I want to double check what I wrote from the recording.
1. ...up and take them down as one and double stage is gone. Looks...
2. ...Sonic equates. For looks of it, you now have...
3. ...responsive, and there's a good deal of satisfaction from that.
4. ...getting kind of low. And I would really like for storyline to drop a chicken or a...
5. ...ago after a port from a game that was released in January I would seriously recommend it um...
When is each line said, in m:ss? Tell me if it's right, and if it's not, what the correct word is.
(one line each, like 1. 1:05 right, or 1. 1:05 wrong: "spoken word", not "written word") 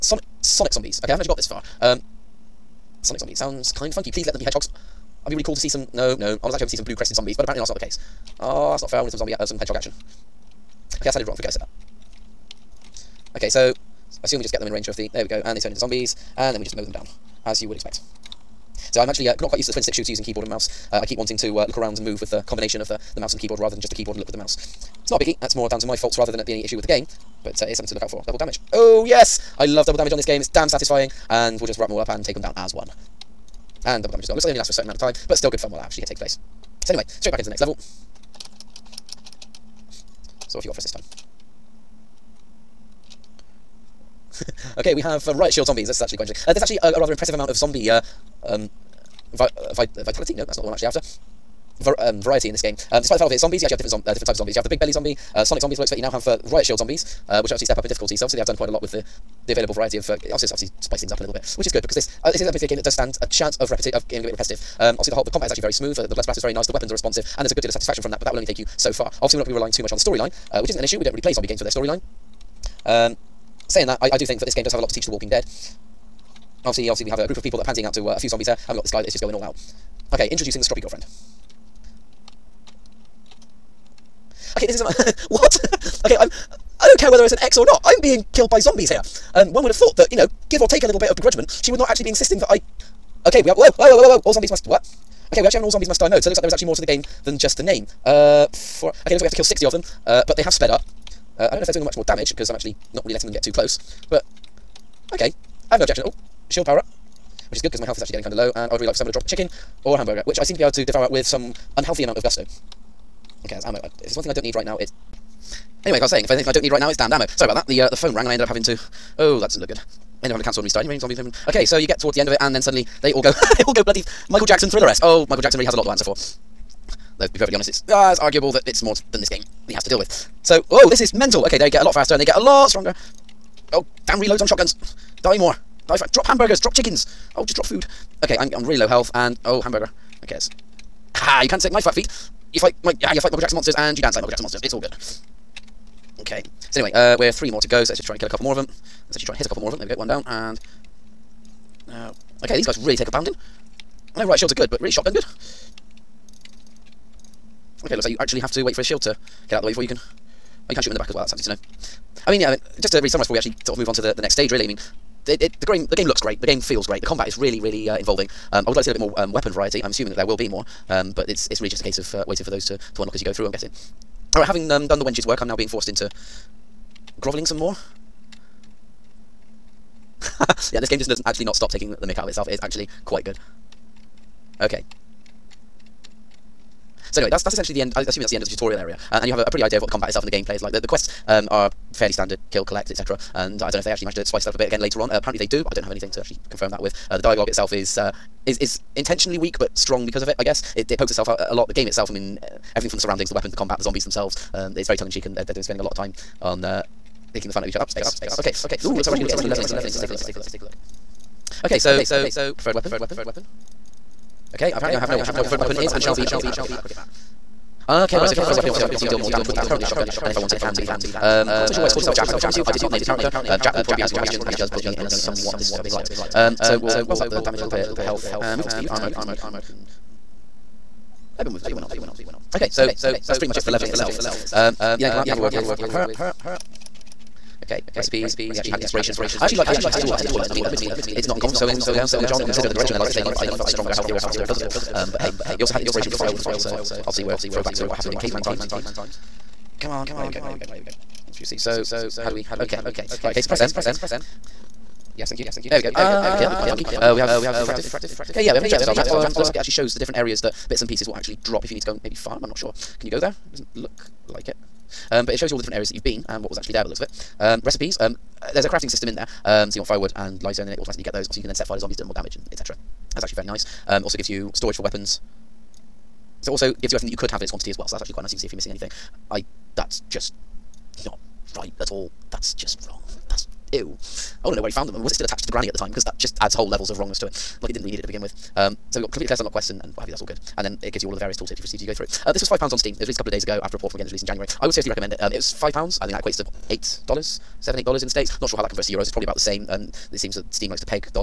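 1. 0:31 wrong: "damage", not "stage"
2. 0:55 wrong: "zombies", not "equates"
3. 1:06 right
4. 1:48 wrong: "someone", not "storyline"
5. 4:53 right.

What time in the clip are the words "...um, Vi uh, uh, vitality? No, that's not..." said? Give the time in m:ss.
0:48.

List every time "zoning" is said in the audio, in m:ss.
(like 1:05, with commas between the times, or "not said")
not said.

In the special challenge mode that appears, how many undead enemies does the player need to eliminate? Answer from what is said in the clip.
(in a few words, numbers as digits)
60.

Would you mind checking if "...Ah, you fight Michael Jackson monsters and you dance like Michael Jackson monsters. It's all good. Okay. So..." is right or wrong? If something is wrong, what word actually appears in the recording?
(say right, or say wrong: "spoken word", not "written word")
right.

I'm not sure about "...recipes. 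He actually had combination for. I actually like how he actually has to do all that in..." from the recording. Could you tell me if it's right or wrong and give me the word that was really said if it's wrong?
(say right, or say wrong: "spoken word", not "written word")
wrong: "inspiration", not "combination".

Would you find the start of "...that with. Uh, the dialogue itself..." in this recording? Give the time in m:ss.
3:16.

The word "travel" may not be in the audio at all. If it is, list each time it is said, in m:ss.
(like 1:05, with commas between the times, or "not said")
not said.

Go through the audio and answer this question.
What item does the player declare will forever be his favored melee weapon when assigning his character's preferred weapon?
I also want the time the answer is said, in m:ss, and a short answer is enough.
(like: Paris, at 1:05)
Cricket bat, at 3:36.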